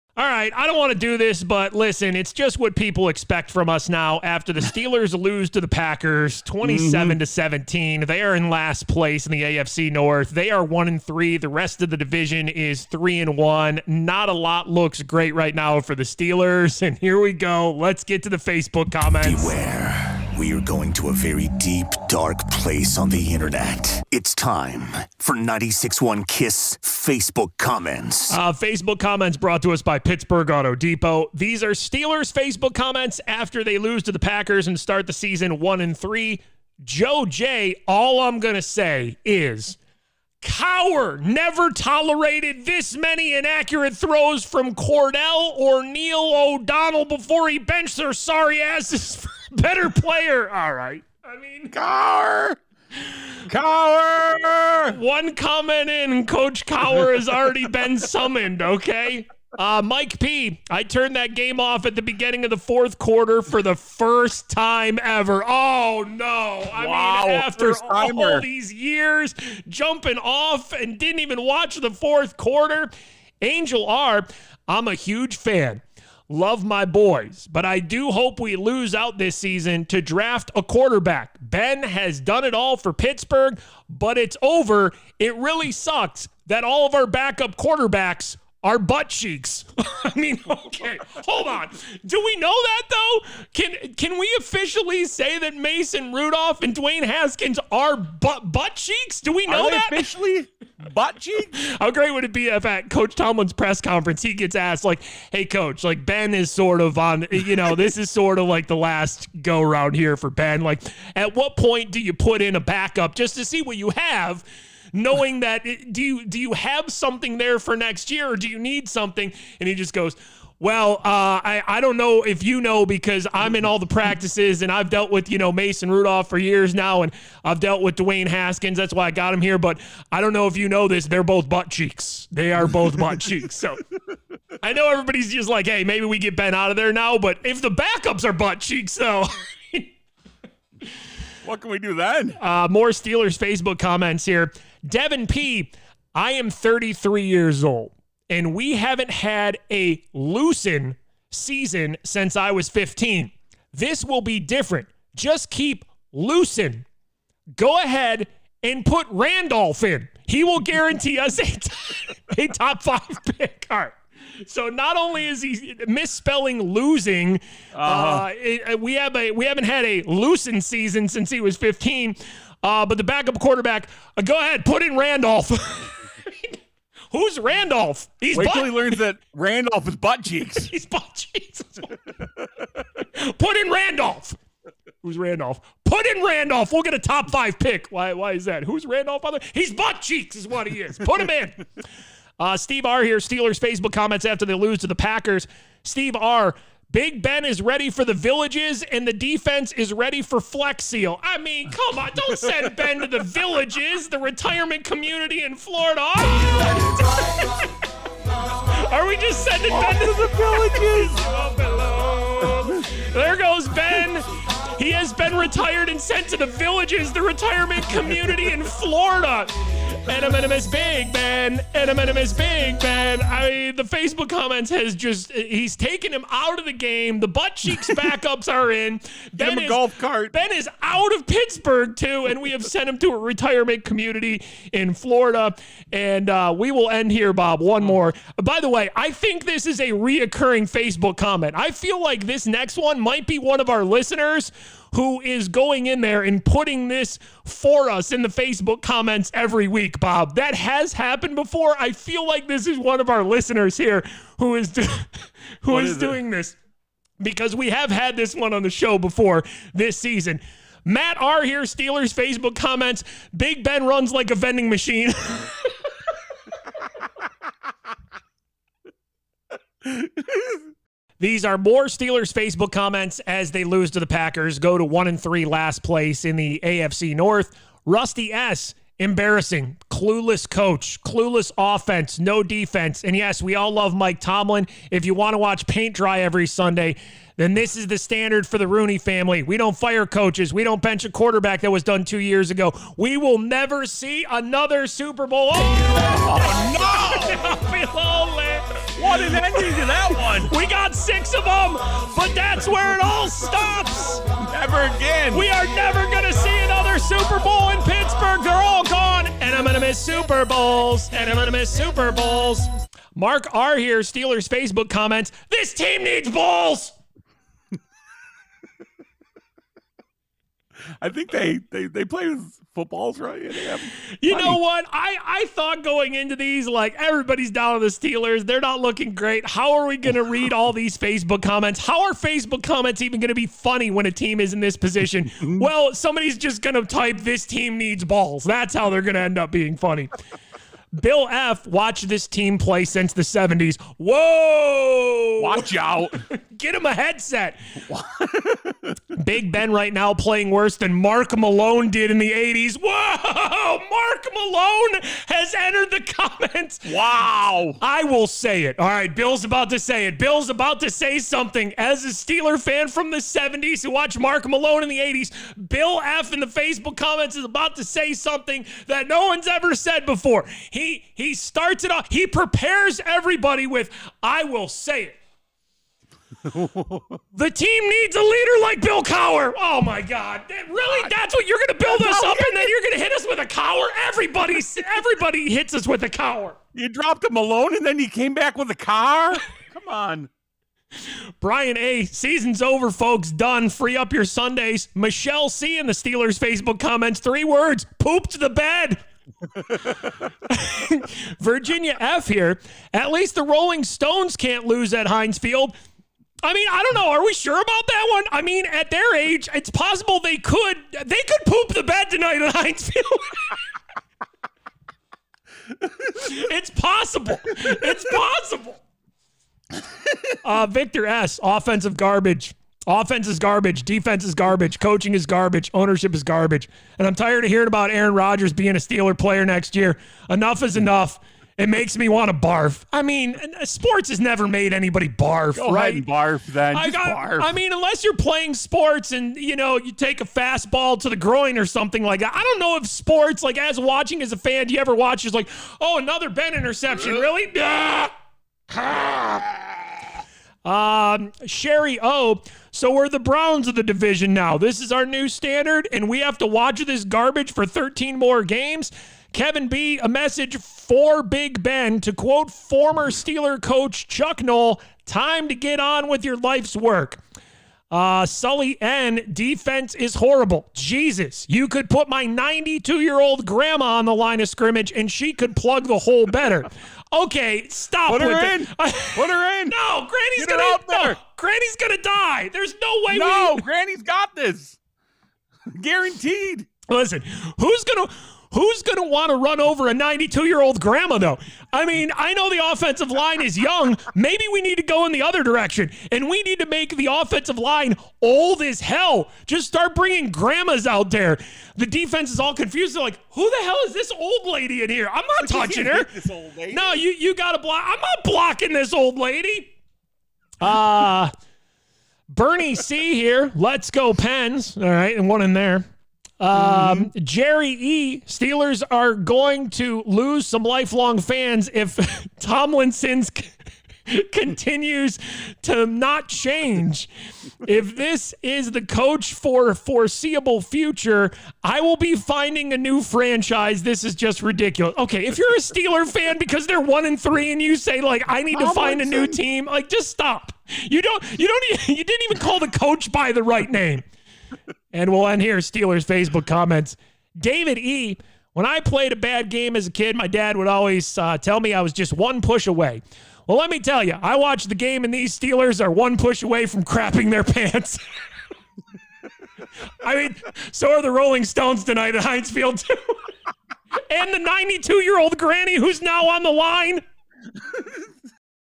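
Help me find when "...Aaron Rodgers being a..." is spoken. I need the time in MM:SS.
07:07.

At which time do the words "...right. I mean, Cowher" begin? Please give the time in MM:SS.
00:50.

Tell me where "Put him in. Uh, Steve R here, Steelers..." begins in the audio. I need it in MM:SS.
03:10.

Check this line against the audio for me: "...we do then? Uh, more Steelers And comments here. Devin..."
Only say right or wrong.
wrong.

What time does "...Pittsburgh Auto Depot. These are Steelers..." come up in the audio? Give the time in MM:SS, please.
00:29.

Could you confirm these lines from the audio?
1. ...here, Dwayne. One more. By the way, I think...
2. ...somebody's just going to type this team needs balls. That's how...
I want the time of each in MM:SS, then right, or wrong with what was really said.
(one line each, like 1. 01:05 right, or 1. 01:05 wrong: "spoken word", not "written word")
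1. 03:57 wrong: "Bob", not "Dwayne"
2. 05:35 right.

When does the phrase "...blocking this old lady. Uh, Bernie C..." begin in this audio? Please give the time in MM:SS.
08:28.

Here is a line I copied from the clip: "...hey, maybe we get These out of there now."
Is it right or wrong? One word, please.
wrong.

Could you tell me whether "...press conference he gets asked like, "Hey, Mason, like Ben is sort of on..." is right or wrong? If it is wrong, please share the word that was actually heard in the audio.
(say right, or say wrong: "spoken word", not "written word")
wrong: "Coach", not "Mason".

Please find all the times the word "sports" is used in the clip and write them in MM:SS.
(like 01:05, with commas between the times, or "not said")
07:13, 07:18, 07:22.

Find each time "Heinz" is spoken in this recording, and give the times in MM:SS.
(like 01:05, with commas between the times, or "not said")
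06:45, 06:52, 09:22.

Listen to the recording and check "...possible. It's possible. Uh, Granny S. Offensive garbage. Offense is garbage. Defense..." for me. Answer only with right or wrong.
wrong.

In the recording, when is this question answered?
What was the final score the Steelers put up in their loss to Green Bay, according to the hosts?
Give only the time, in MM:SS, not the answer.
00:07.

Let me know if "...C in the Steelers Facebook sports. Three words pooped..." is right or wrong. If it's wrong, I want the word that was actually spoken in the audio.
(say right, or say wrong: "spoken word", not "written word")
wrong: "comments", not "sports".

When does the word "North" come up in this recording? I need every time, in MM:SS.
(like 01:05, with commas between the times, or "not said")
00:09, 04:37.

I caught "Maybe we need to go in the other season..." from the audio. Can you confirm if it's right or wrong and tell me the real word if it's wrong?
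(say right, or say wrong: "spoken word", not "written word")
wrong: "direction", not "season".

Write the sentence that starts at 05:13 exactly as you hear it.
Mark R here, Steelers Facebook comments.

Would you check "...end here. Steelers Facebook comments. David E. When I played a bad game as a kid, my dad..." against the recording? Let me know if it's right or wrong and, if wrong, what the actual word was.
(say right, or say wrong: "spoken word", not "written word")
right.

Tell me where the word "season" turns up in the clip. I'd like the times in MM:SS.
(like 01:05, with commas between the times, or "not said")
00:35, 01:19, 02:31, 02:50, 04:19, 06:32.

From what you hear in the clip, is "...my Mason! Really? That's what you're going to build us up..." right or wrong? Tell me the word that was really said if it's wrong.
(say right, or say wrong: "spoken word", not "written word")
wrong: "God", not "Mason".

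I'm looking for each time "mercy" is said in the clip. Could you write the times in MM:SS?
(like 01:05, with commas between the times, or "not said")
not said.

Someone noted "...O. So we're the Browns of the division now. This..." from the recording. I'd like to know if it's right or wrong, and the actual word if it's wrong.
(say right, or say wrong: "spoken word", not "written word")
right.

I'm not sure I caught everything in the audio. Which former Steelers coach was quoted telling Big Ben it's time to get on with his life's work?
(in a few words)
Chuck Noll.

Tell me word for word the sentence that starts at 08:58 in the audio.
to find a new team, like just stop.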